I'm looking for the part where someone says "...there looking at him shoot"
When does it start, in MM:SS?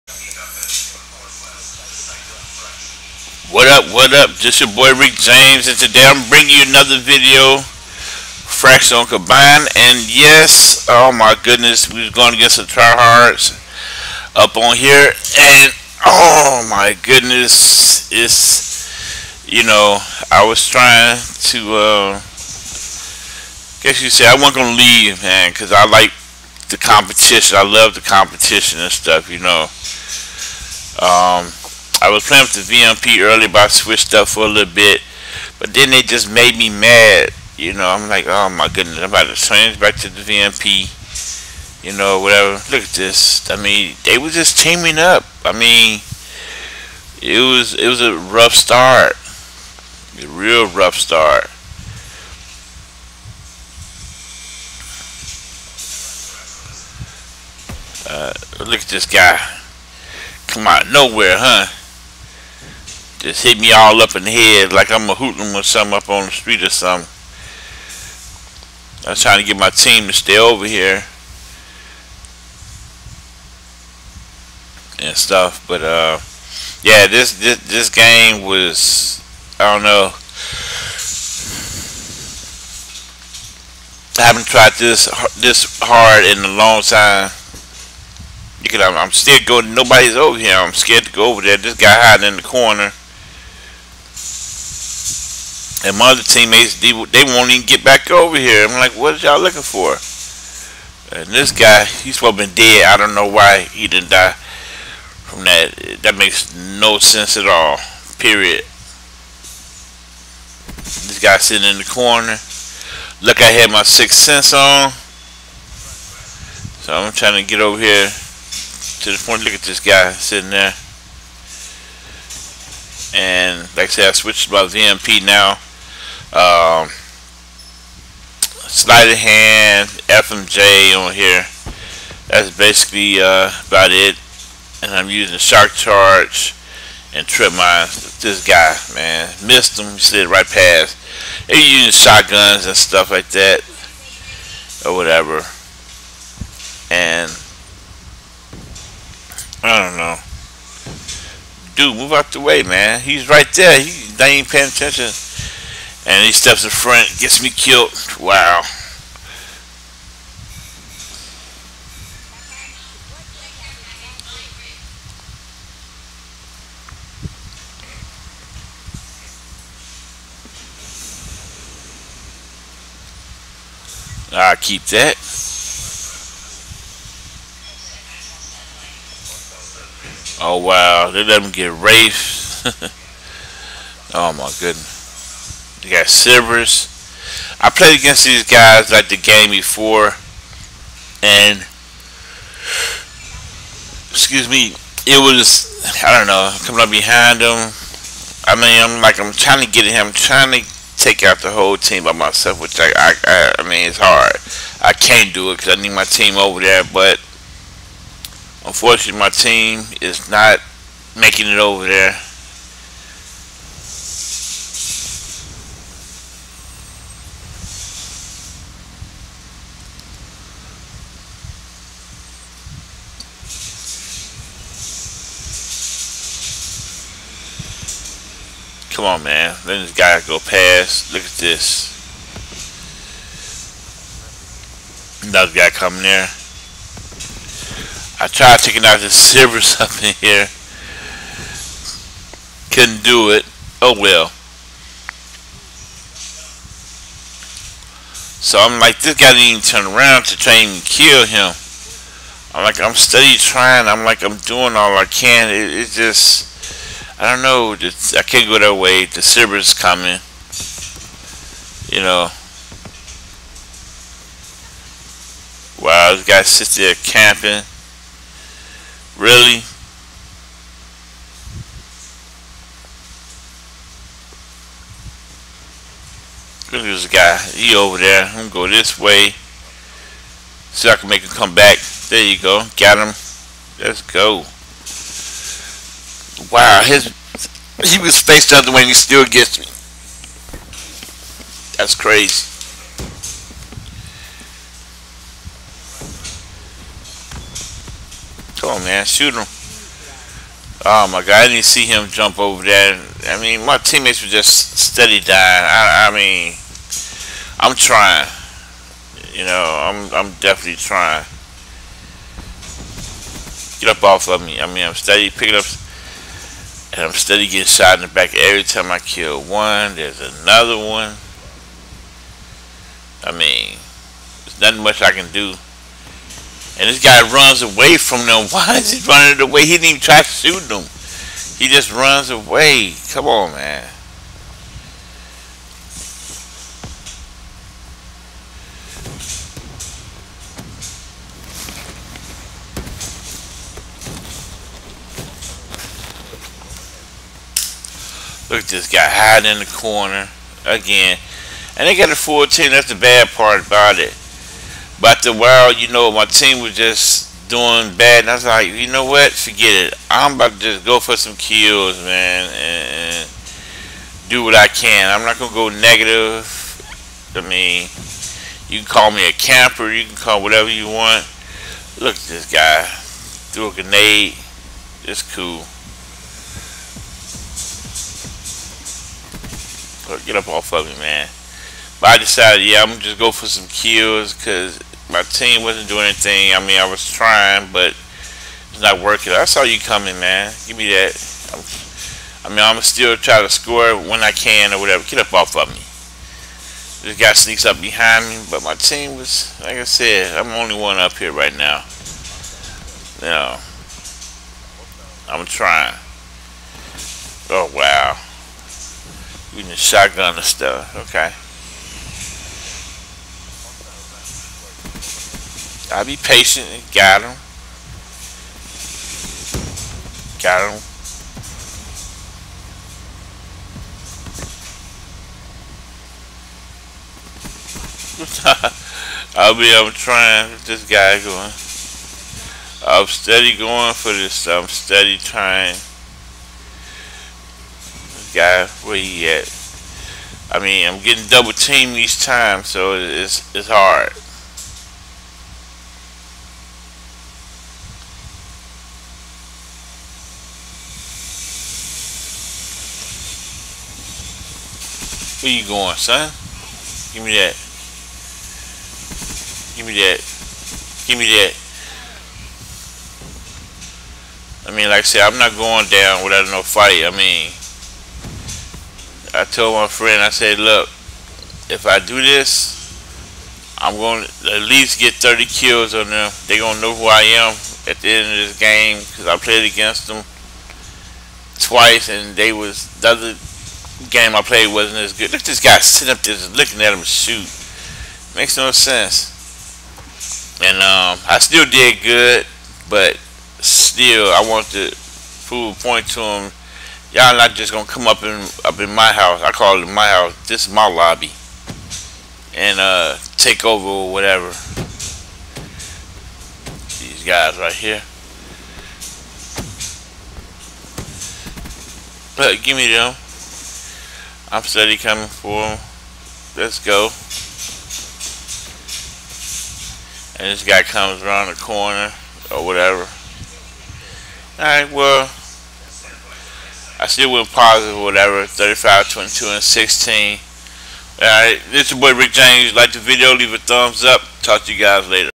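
08:06.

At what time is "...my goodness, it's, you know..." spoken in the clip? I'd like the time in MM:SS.
00:16.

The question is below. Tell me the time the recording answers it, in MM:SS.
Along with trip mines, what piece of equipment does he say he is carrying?
02:15.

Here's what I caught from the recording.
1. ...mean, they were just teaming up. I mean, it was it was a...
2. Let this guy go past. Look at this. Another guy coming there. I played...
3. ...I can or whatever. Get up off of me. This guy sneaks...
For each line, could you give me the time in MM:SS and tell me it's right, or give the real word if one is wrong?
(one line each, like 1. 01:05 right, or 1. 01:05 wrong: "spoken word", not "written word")
1. 00:43 right
2. 03:49 wrong: "tried", not "played"
3. 06:34 right.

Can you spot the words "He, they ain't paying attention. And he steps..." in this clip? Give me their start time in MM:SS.
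02:33.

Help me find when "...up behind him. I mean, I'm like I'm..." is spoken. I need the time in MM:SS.
03:16.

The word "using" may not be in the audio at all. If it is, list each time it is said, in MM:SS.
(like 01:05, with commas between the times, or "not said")
02:15, 02:21.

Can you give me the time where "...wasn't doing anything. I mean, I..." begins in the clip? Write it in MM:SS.
06:25.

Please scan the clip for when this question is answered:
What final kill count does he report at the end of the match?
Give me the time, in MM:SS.
08:48.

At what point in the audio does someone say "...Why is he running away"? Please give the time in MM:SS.
05:28.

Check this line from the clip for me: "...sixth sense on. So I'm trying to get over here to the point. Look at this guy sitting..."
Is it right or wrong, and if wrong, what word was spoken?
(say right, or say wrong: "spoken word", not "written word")
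right.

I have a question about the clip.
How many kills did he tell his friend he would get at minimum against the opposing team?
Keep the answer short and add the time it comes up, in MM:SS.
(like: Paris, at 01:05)
30, at 07:55.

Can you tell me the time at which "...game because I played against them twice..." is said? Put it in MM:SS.
07:58.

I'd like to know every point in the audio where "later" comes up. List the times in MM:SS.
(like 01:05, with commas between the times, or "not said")
08:55.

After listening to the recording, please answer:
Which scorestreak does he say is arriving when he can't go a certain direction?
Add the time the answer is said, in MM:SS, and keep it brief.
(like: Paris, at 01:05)
Cerberus, at 04:19.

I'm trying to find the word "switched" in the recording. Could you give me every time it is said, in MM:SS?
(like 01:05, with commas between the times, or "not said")
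00:33, 02:04.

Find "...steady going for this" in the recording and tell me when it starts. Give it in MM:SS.
07:13.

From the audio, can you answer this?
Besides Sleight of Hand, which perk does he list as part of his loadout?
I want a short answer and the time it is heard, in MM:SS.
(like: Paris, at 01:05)
FMJ, at 02:10.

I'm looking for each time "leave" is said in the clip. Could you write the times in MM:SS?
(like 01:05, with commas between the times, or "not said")
00:24, 08:53.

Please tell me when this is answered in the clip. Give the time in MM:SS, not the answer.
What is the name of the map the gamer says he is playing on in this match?
00:07.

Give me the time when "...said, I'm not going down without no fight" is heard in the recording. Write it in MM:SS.
07:45.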